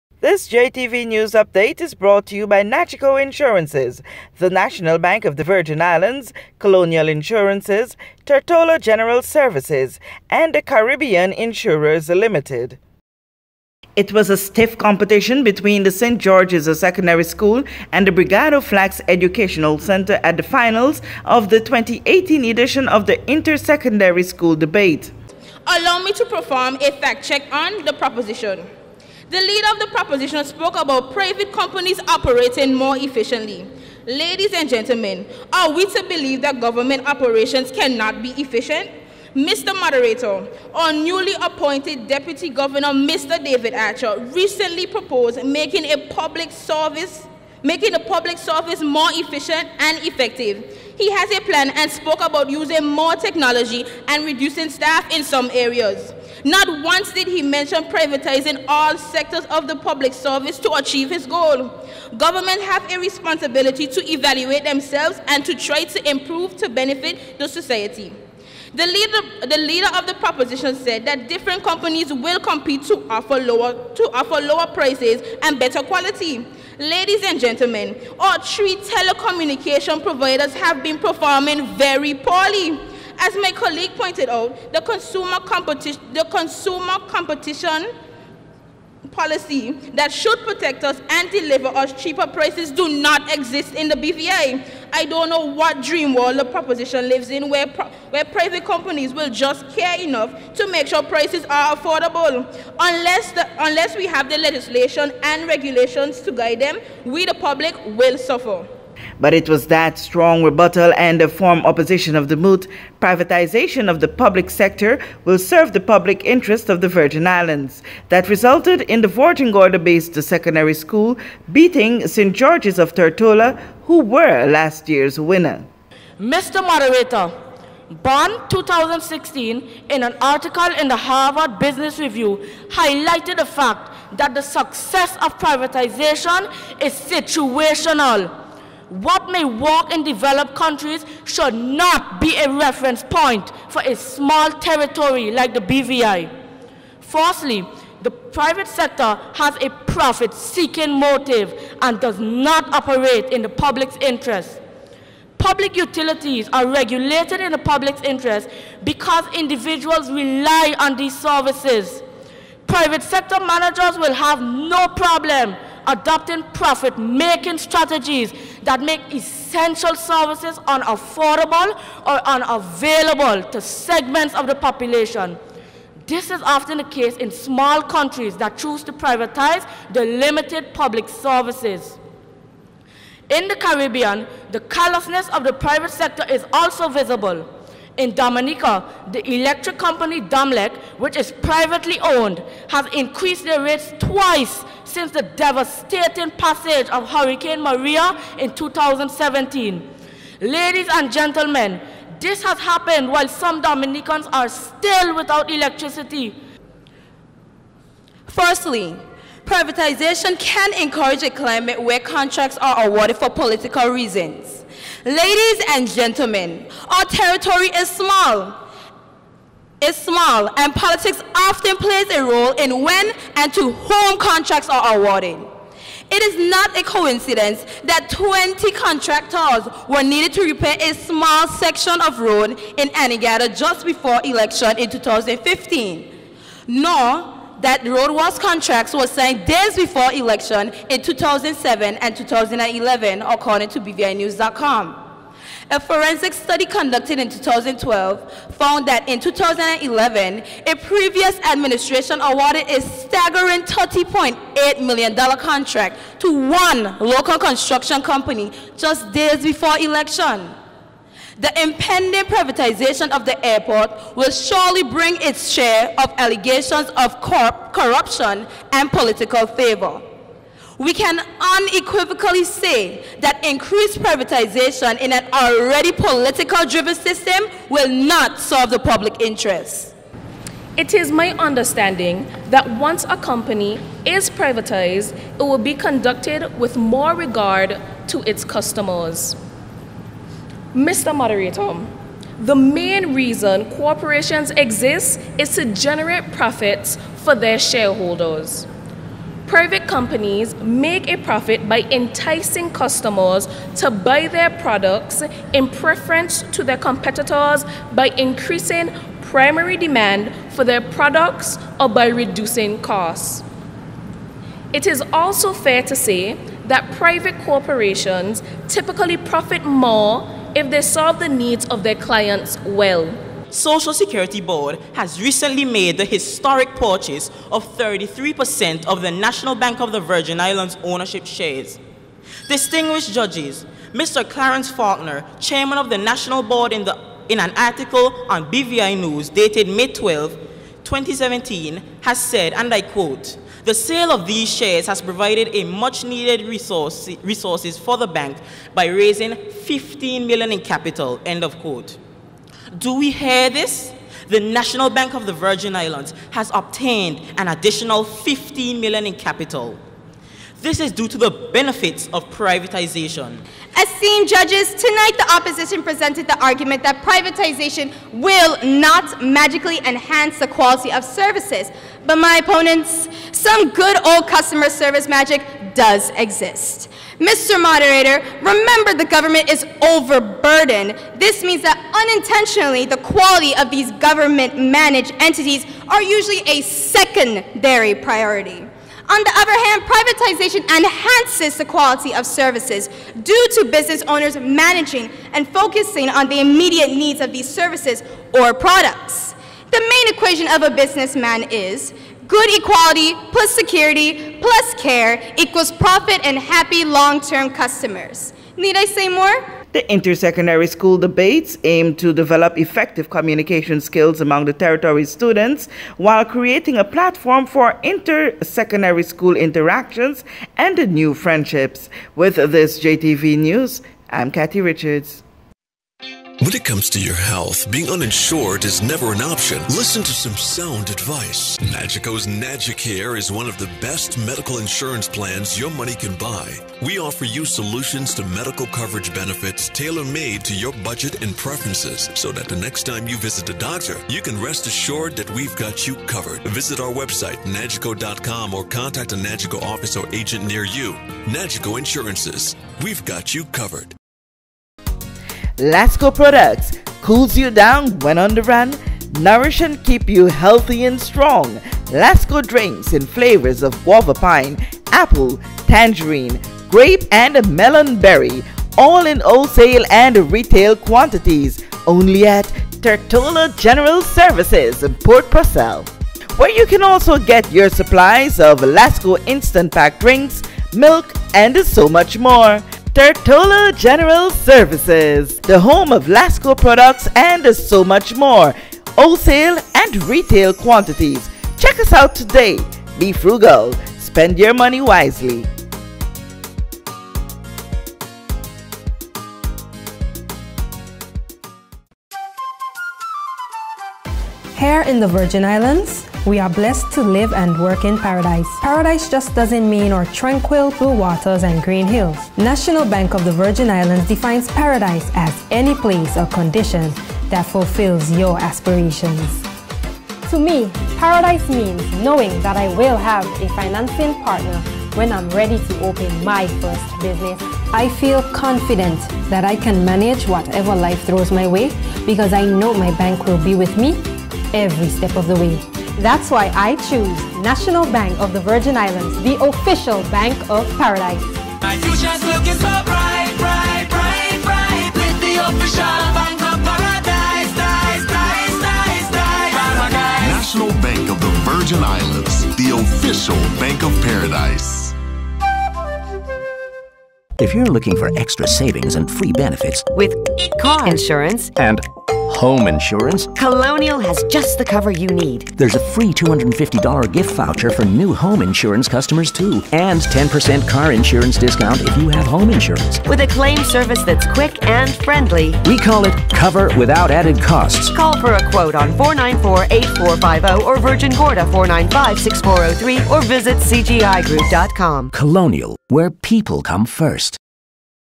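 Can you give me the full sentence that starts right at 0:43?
David Archer, recently proposed making a public service making the public service more efficient and effective.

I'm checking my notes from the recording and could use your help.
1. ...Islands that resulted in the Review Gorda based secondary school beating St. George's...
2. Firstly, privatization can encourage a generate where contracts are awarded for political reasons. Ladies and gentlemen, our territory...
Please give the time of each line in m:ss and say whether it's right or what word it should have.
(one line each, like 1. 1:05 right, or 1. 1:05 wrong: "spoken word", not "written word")
1. 1:57 wrong: "Virgin", not "Review"
2. 3:28 wrong: "climate", not "generate".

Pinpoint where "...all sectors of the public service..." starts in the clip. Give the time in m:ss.
0:58.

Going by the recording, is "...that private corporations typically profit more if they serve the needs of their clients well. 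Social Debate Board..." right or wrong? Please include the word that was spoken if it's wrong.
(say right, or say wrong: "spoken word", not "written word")
wrong: "Security", not "Debate".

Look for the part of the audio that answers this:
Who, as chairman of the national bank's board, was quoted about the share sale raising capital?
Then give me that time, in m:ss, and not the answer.
5:34.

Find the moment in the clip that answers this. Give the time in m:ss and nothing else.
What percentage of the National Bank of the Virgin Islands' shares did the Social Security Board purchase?
5:27.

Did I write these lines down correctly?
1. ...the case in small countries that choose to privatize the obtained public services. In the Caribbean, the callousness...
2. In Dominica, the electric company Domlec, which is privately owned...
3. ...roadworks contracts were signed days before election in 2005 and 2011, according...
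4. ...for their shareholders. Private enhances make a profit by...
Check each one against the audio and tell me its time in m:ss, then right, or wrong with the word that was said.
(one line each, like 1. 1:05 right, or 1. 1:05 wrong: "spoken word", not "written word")
1. 2:56 wrong: "limited", not "obtained"
2. 3:07 right
3. 3:57 wrong: "2007", not "2005"
4. 4:57 wrong: "companies", not "enhances".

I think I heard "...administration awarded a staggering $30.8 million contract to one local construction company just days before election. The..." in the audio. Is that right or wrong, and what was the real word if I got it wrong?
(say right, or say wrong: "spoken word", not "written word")
right.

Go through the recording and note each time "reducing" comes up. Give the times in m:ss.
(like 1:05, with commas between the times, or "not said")
0:54, 5:12.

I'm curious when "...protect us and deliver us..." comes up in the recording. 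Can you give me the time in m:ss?
1:30.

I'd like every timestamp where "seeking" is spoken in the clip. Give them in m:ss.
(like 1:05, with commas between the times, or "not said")
2:29.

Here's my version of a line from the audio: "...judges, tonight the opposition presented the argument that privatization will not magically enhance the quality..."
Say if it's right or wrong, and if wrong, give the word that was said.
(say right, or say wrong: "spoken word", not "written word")
right.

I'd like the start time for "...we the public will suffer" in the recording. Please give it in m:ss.
1:47.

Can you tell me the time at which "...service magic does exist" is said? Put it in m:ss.
6:14.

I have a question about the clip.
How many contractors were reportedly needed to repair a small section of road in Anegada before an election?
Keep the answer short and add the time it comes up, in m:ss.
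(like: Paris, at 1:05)
20, at 3:48.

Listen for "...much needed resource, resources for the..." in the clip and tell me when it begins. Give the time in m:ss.
5:45.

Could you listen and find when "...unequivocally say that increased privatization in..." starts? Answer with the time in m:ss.
4:31.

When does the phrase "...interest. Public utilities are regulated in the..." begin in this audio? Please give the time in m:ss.
2:34.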